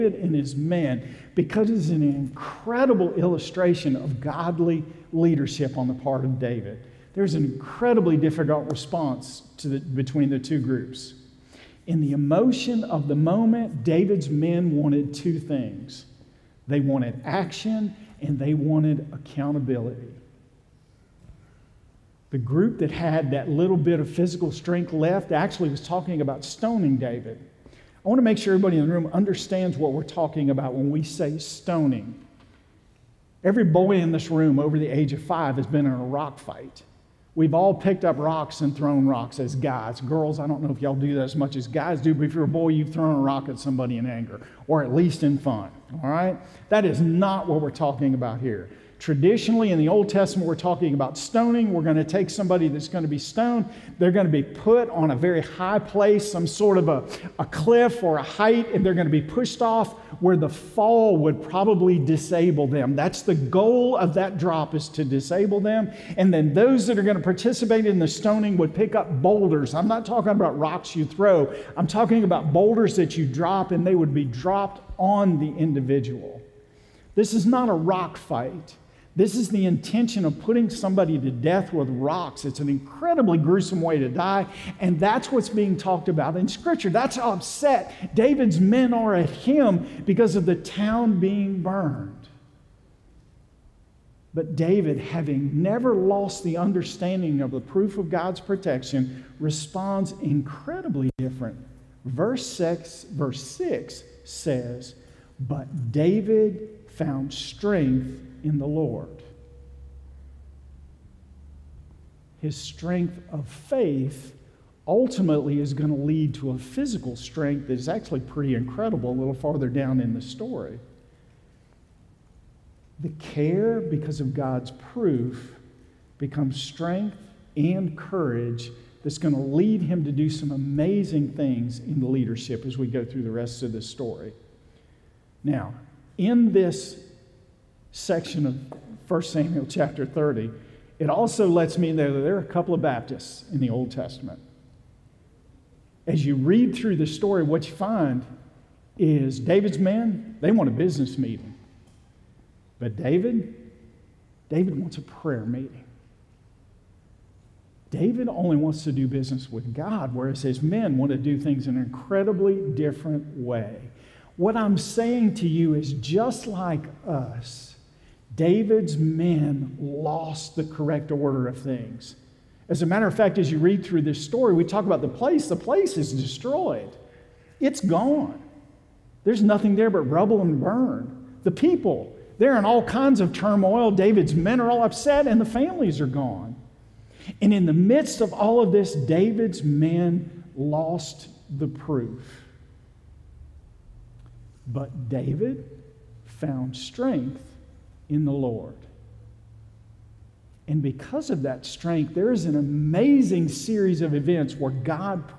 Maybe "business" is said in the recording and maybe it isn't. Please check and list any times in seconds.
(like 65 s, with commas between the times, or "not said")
150 s, 159 s.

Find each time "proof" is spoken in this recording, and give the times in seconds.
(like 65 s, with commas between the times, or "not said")
97 s, 124 s, 191 s.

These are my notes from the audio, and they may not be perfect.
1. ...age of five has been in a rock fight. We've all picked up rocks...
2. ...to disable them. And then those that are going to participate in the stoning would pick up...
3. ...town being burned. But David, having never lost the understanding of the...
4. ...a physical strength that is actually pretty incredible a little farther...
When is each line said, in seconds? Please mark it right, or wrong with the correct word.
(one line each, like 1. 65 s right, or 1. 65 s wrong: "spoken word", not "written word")
1. 34 s right
2. 64 s right
3. 90 s right
4. 116 s right.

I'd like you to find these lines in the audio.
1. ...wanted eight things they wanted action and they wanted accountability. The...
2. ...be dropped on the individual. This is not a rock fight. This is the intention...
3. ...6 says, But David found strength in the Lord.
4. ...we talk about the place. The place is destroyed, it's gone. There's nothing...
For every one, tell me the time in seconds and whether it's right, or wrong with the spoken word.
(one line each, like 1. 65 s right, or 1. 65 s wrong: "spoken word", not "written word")
1. 14 s wrong: "two", not "eight"
2. 74 s right
3. 103 s right
4. 174 s right.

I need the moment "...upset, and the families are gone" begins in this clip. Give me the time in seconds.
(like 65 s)
184 s.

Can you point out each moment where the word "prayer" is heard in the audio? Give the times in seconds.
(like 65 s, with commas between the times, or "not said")
155 s.